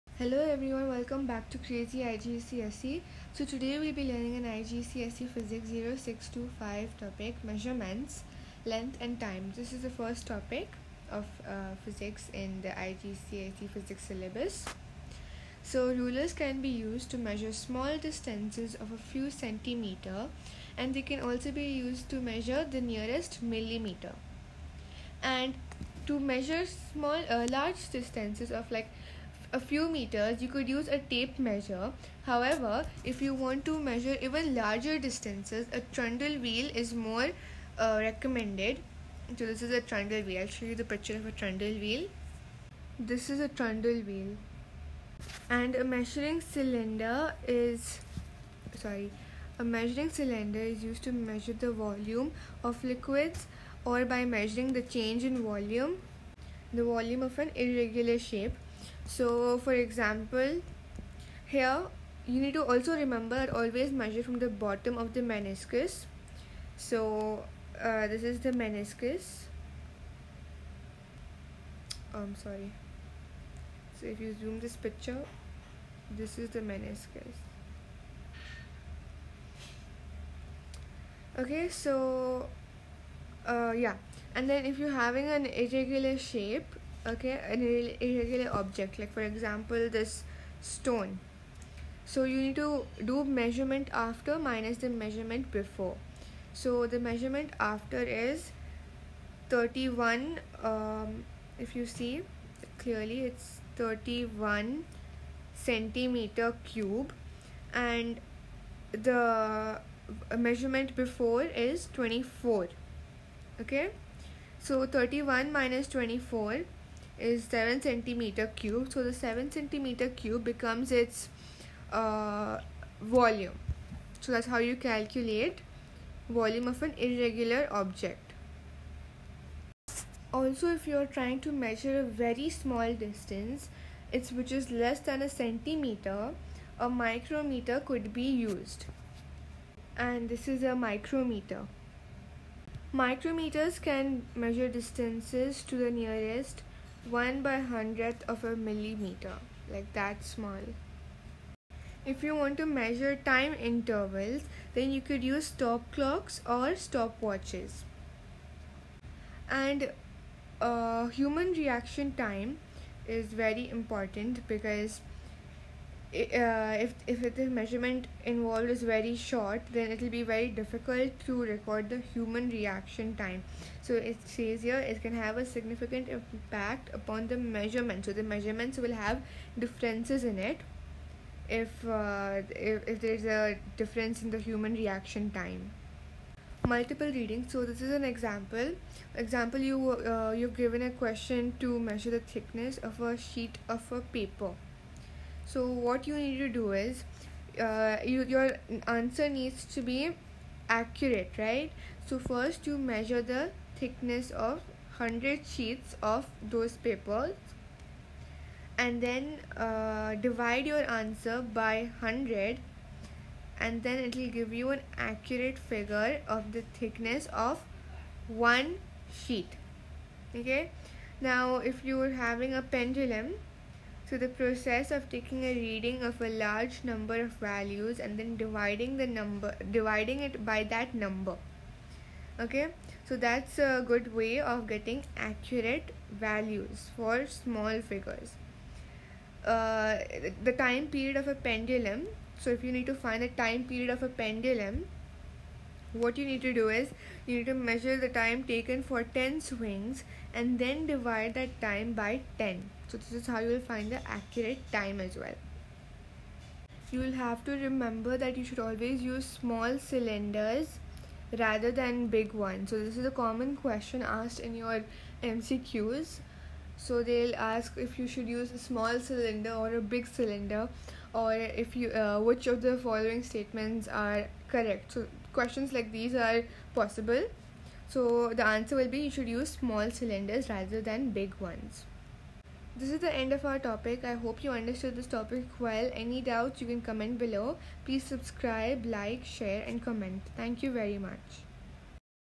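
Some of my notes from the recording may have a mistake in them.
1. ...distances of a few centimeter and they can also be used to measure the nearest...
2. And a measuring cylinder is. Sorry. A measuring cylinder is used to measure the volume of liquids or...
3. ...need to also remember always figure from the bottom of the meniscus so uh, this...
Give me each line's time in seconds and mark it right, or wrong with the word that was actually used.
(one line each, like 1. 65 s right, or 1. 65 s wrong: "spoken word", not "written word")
1. 17 s right
2. 45 s right
3. 62 s wrong: "measure", not "figure".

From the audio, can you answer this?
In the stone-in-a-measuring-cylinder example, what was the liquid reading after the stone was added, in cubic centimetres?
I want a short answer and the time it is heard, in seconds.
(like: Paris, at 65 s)
31, at 103 s.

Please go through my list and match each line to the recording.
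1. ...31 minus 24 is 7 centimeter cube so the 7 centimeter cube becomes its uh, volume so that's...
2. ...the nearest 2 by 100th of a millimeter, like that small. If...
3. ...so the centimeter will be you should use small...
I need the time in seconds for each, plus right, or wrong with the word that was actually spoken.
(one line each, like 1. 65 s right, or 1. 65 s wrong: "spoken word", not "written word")
1. 114 s right
2. 145 s wrong: "1", not "2"
3. 277 s wrong: "answer", not "centimeter".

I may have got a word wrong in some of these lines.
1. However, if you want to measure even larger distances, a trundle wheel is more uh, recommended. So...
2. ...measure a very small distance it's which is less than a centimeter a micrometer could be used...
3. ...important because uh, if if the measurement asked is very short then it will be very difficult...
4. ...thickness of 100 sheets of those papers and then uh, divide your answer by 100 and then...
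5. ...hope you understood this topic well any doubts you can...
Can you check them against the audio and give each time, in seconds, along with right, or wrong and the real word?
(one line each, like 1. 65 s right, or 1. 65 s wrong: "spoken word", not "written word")
1. 32 s right
2. 131 s right
3. 163 s wrong: "involved", not "asked"
4. 203 s right
5. 284 s right.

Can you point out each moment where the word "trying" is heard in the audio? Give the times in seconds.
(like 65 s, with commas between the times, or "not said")
131 s.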